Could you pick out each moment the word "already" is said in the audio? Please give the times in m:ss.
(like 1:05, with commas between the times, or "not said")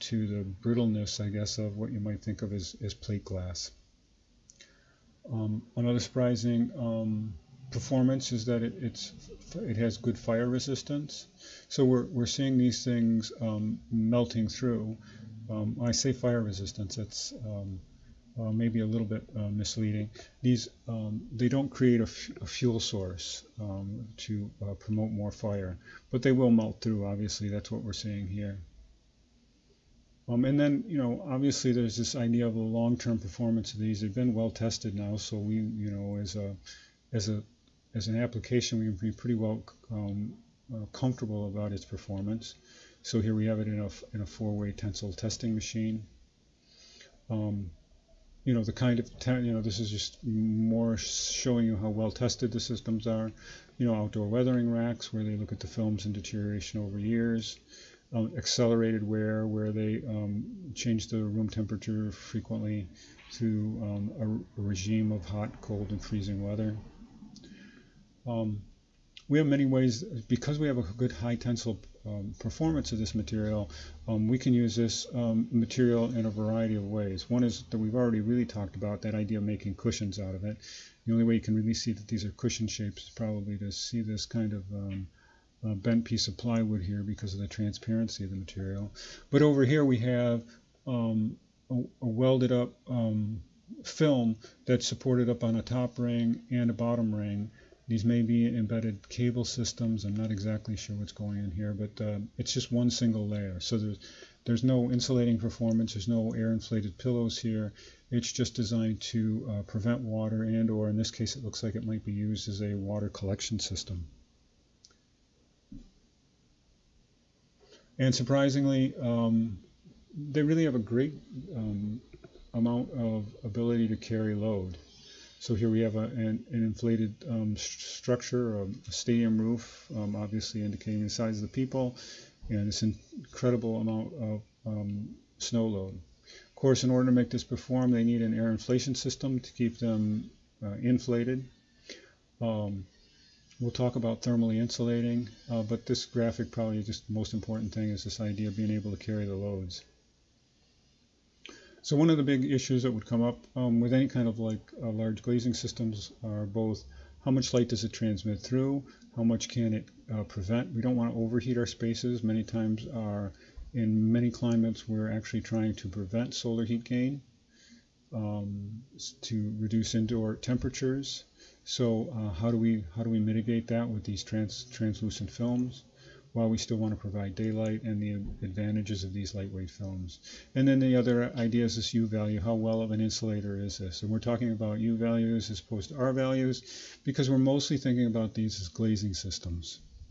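1:17.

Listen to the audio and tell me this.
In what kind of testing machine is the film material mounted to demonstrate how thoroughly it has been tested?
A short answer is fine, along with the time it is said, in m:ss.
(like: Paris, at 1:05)
four-way tensile testing machine, at 0:44.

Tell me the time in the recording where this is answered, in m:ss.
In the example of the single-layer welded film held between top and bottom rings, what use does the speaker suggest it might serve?
1:52.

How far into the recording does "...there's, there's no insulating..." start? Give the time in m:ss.
1:43.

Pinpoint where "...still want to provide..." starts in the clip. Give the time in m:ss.
2:56.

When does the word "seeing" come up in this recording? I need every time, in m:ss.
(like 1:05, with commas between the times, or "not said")
0:12, 0:27.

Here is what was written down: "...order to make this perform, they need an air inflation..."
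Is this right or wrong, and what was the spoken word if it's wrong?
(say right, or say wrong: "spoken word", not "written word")
right.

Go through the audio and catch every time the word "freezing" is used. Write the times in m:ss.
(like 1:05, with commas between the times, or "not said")
1:06.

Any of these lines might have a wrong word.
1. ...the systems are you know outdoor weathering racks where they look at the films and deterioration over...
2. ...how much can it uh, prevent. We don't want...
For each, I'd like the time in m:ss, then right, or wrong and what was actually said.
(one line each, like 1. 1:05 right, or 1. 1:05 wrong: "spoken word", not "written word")
1. 0:52 right
2. 2:39 right.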